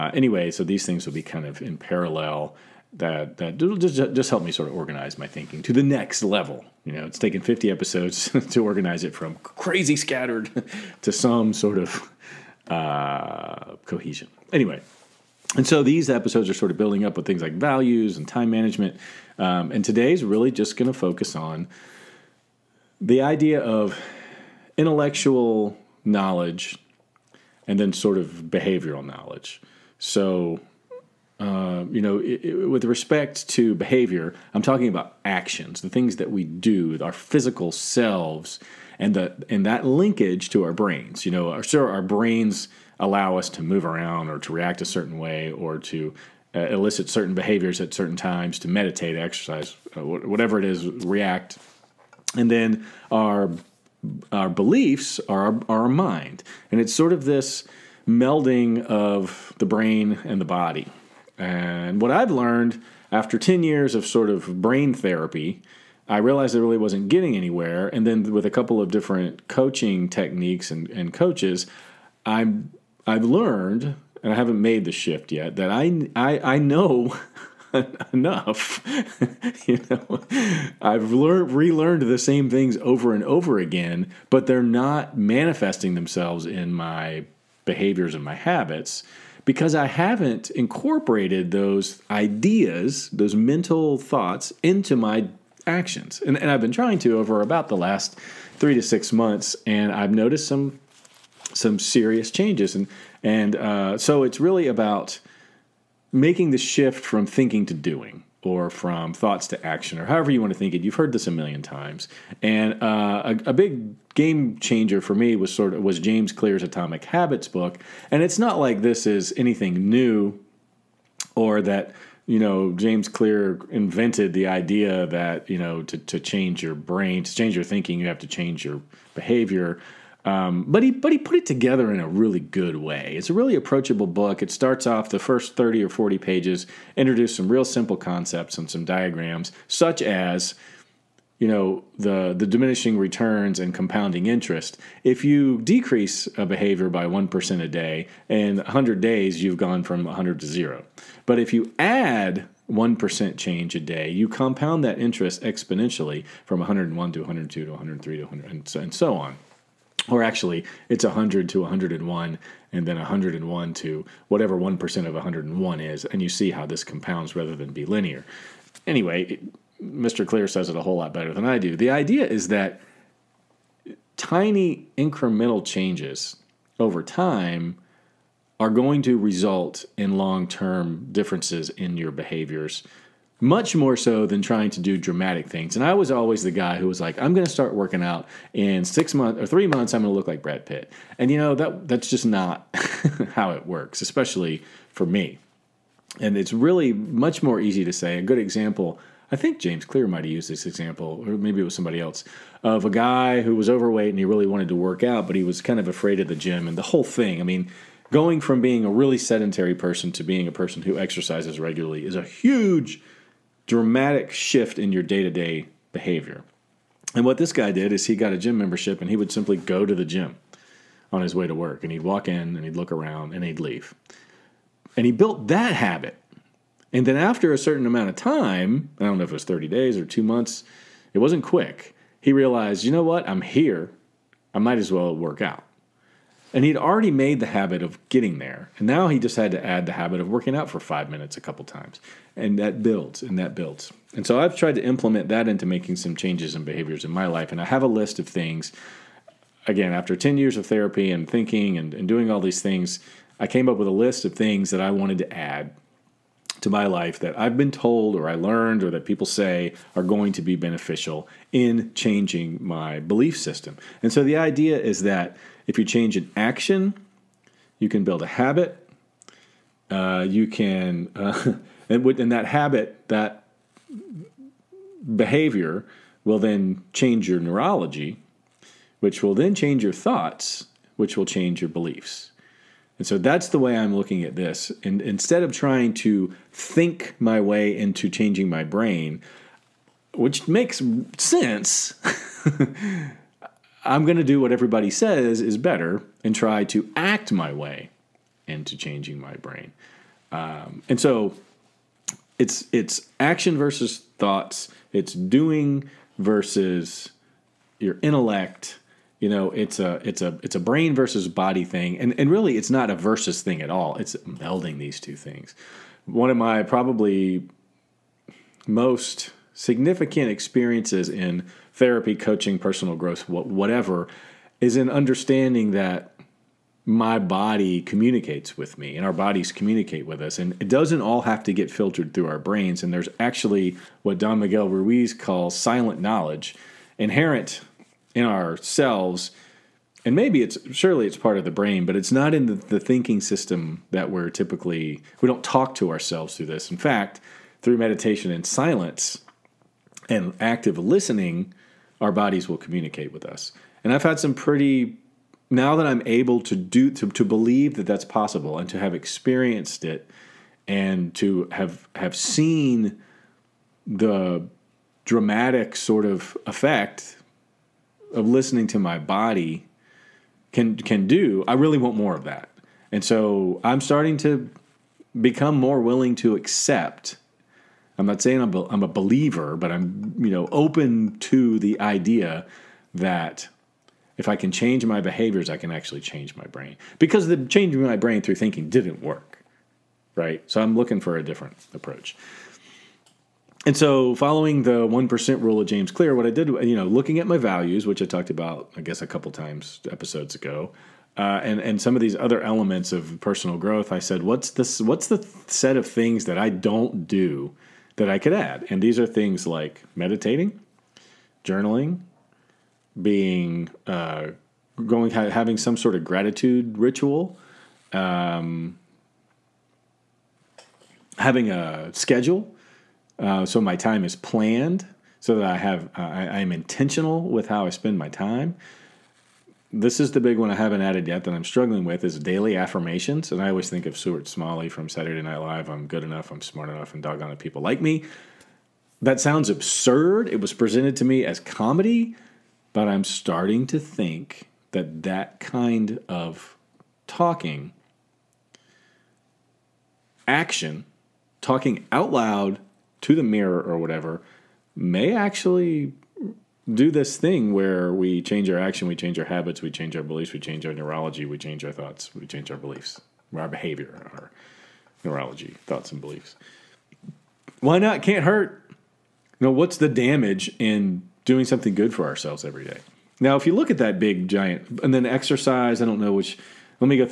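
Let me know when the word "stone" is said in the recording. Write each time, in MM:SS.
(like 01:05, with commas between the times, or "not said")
not said.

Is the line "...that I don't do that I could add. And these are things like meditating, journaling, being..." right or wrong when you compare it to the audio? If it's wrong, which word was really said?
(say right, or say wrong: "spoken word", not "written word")
right.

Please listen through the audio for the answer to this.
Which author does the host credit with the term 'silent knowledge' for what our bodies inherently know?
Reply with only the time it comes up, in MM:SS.
05:34.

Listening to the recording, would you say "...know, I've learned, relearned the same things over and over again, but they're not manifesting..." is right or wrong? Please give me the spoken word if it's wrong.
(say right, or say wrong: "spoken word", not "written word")
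right.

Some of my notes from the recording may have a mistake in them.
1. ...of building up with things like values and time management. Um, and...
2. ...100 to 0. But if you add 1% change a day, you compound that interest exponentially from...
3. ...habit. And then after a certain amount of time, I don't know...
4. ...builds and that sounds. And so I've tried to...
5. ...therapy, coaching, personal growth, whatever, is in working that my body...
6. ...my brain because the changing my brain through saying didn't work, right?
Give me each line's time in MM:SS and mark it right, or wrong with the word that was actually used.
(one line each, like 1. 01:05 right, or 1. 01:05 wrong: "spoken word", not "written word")
1. 00:16 right
2. 02:30 right
3. 03:45 right
4. 04:02 wrong: "builds", not "sounds"
5. 05:21 wrong: "understanding", not "working"
6. 06:26 wrong: "thinking", not "saying".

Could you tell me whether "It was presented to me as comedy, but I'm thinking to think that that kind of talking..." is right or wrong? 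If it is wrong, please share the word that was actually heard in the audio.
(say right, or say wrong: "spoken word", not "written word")
wrong: "starting", not "thinking".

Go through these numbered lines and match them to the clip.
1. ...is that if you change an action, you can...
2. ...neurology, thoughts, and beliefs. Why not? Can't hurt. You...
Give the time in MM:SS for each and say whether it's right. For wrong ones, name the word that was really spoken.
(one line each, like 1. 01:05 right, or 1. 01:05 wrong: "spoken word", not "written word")
1. 04:24 right
2. 07:45 right.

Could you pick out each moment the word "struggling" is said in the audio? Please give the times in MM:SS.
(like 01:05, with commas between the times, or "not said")
07:11.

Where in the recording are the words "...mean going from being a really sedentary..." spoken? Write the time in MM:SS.
03:27.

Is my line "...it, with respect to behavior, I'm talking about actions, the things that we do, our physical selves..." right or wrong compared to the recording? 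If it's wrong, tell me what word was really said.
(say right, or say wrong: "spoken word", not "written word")
right.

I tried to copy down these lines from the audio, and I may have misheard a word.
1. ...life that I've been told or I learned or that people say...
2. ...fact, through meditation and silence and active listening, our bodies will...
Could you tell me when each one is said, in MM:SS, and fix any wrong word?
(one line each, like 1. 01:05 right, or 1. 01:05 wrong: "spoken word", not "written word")
1. 04:16 right
2. 05:46 right.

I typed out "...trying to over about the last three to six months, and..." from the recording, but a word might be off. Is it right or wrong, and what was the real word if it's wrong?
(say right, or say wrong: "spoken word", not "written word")
right.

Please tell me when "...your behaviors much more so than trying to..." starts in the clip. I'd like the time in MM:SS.
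03:01.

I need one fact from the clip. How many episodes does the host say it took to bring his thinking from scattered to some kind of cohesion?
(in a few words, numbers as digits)
50.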